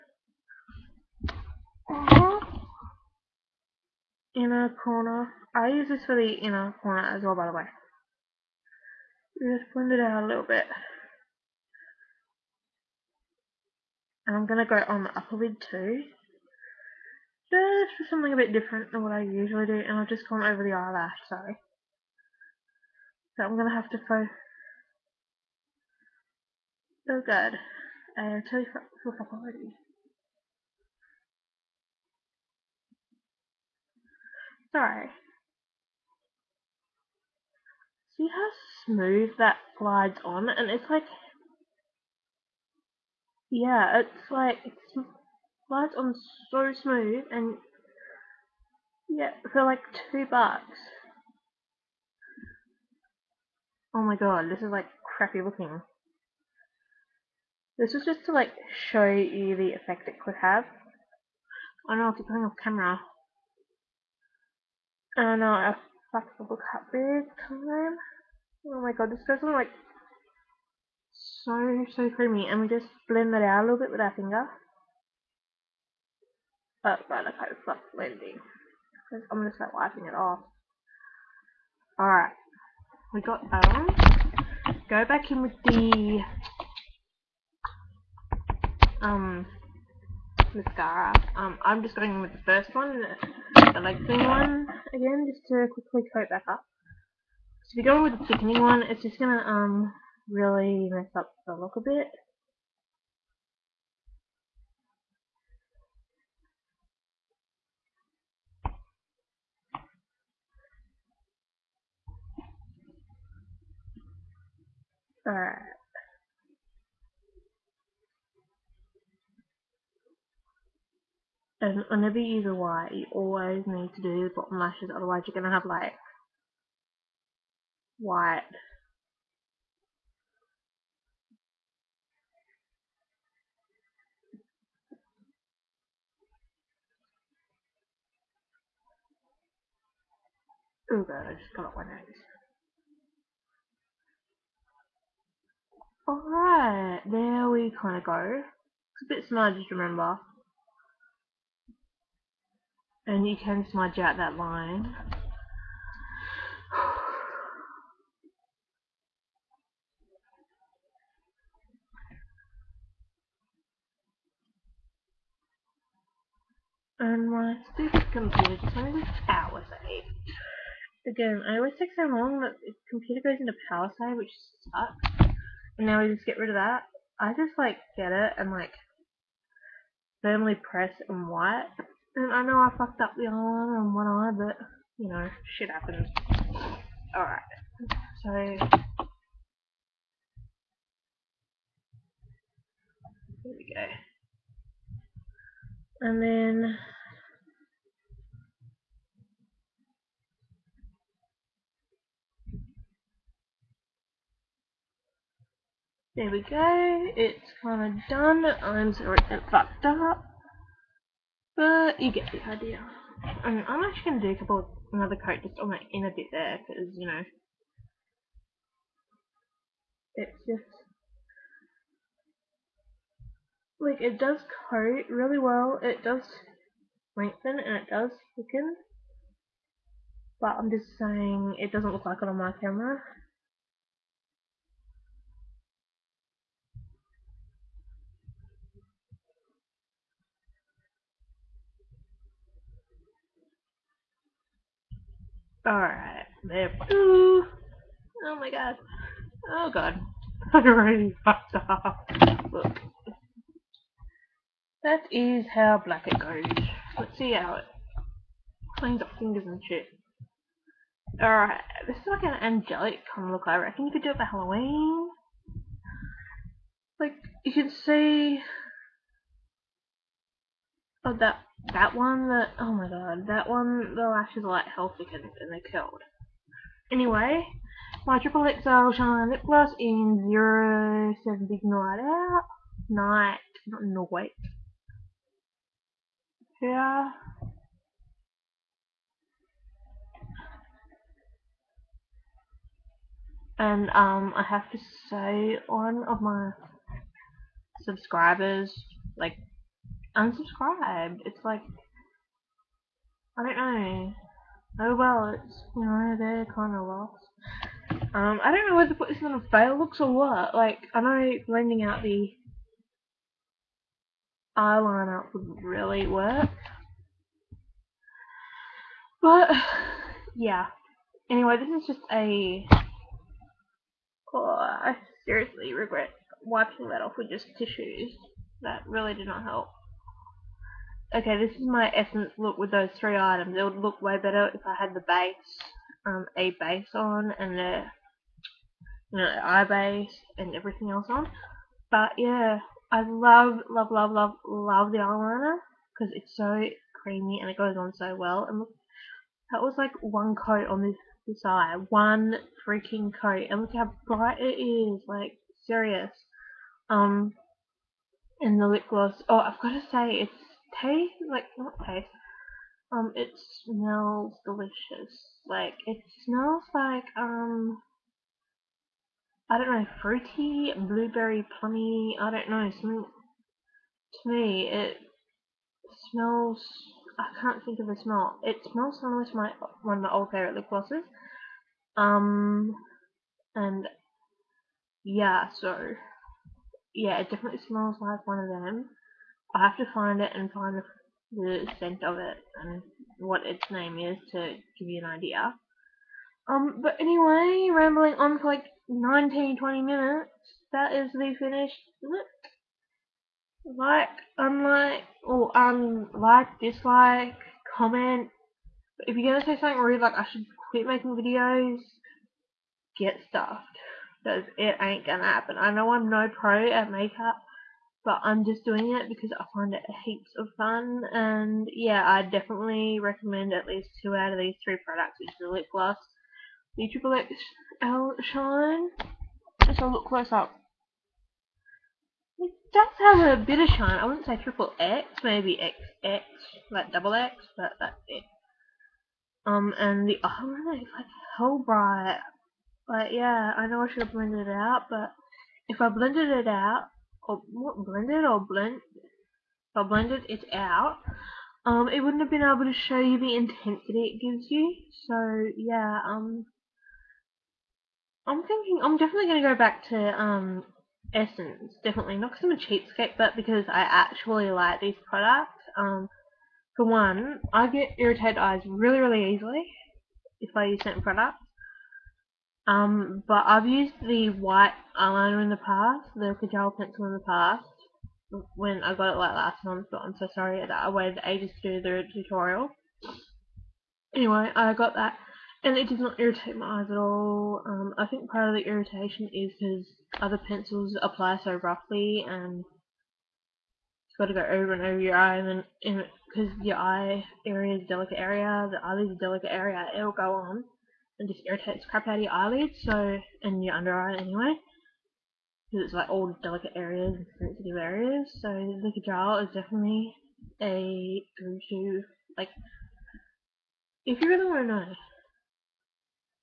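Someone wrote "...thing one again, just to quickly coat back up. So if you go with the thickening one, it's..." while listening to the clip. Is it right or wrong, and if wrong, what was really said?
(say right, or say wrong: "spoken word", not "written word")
right.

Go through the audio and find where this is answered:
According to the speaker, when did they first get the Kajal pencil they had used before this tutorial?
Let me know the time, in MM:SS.
07:59.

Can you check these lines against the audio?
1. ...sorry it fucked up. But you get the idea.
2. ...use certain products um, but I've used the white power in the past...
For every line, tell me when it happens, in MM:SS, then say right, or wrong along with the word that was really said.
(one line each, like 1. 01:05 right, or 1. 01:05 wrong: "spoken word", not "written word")
1. 03:28 right
2. 07:50 wrong: "eyeliner", not "power".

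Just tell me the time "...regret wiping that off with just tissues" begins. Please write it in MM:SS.
05:25.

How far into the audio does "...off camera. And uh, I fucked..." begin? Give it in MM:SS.
01:02.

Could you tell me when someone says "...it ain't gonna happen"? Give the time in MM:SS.
06:54.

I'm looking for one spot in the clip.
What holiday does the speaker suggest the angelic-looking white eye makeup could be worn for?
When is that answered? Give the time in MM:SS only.
04:24.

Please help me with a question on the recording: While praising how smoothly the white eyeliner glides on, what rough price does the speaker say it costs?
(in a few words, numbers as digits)
$2.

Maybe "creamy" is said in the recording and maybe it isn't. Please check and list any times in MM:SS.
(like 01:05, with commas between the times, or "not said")
01:12, 05:47.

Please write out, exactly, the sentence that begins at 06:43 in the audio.
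Like, unlike, or um, like, dislike, comment.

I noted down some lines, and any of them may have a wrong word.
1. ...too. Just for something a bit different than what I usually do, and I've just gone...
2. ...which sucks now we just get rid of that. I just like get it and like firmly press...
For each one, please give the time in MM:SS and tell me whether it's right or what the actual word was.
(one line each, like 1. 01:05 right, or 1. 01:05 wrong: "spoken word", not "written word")
1. 00:15 right
2. 02:54 right.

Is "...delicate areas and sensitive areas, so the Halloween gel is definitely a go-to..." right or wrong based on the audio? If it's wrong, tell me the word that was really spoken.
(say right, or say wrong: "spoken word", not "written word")
wrong: "Kajal", not "Halloween".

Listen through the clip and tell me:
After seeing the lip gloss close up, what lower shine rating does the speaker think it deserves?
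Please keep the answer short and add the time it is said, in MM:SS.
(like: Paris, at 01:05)
Double X, at 07:16.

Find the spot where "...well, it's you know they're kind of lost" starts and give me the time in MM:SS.
05:04.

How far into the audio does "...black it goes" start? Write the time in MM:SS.
04:15.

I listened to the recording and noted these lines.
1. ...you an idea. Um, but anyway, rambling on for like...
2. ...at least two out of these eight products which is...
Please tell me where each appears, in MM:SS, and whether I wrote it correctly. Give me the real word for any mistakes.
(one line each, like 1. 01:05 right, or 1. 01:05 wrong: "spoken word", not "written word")
1. 06:34 right
2. 07:03 wrong: "three", not "eight".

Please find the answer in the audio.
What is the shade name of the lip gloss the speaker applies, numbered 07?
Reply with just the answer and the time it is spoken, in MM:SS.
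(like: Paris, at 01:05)
Big Night Out, at 04:41.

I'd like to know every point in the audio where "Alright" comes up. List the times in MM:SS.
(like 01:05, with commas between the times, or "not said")
01:21, 01:55, 02:26, 03:07, 04:05, 04:21.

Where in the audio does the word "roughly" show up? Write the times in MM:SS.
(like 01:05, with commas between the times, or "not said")
08:11.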